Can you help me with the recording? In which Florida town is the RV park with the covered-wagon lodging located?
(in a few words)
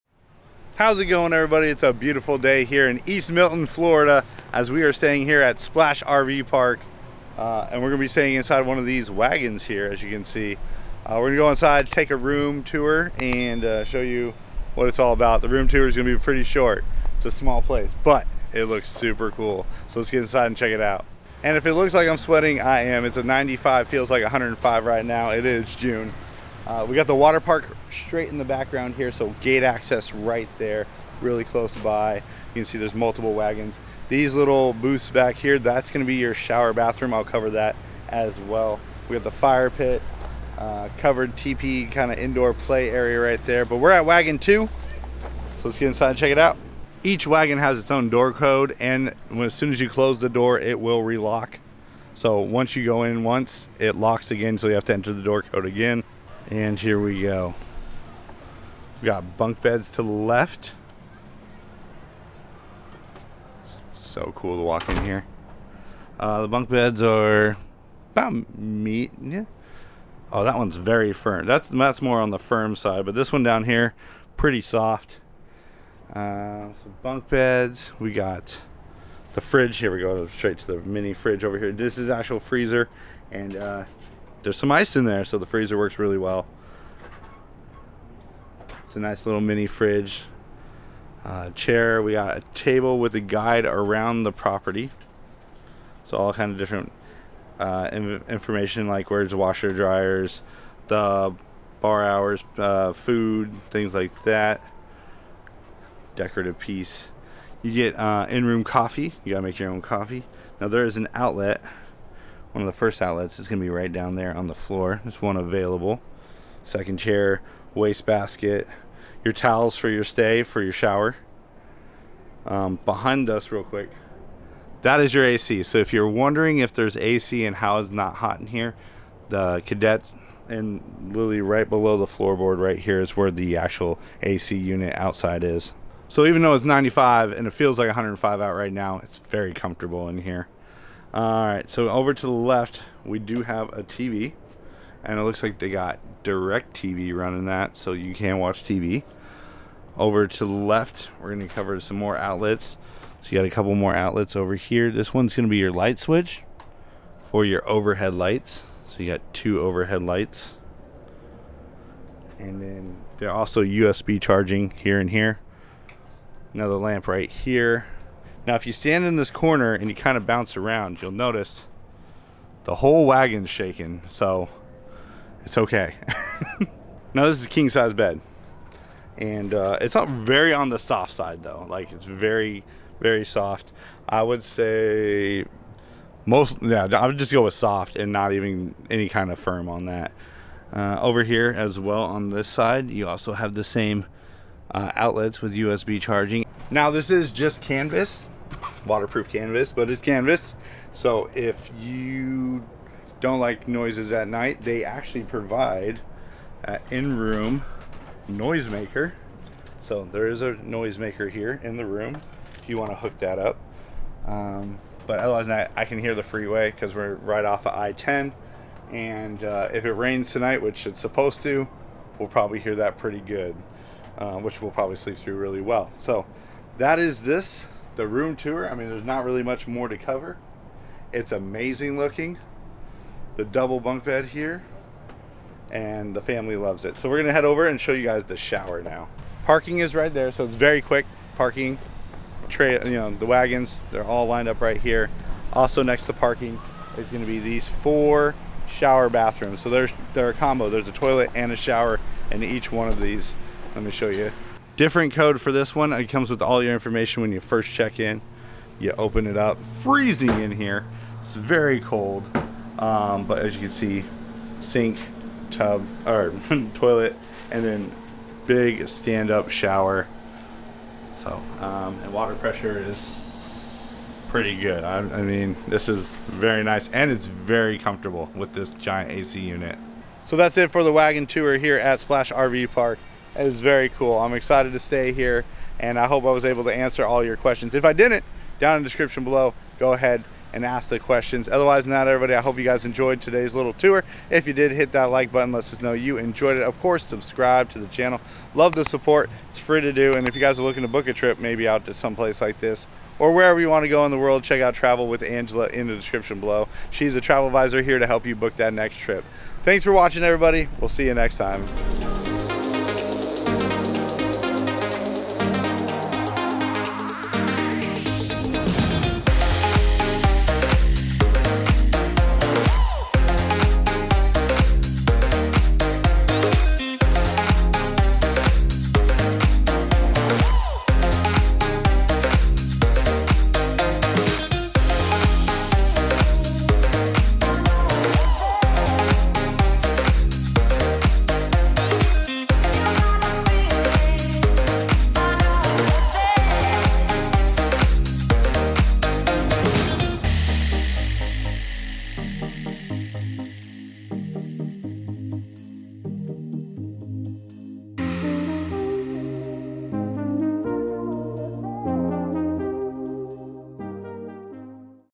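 East Milton.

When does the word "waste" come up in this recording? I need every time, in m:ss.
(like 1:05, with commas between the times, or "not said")
1:57.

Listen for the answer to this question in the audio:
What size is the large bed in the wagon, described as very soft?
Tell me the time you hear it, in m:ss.
2:57.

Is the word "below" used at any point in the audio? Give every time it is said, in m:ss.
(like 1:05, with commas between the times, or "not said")
2:11, 4:49, 5:06.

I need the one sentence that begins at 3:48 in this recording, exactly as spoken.
I mean, there's not really much more to cover.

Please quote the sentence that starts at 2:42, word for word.
And then they're also USB charging here and here.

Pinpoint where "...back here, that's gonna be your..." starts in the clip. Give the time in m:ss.
0:35.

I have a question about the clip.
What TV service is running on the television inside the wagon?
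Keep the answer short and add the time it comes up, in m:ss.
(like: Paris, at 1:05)
DirecTV, at 2:26.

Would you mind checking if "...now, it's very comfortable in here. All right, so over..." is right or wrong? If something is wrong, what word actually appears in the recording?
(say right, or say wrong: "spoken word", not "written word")
right.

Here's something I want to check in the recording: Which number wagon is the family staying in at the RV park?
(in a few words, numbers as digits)
2.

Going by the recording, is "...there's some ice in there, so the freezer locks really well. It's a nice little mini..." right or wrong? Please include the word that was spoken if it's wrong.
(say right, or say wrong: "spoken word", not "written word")
wrong: "works", not "locks".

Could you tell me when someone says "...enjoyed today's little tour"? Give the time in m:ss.
4:52.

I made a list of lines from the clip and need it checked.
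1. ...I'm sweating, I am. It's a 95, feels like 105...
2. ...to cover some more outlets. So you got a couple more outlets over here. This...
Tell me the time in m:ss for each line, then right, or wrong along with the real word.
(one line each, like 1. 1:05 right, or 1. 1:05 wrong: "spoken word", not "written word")
1. 0:22 right
2. 2:31 right.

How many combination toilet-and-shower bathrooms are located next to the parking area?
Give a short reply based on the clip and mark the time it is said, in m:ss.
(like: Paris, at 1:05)
4, at 4:07.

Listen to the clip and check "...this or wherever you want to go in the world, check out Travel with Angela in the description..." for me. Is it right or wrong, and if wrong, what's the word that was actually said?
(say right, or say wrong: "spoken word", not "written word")
right.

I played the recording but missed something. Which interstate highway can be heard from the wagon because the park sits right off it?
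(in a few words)
I-10.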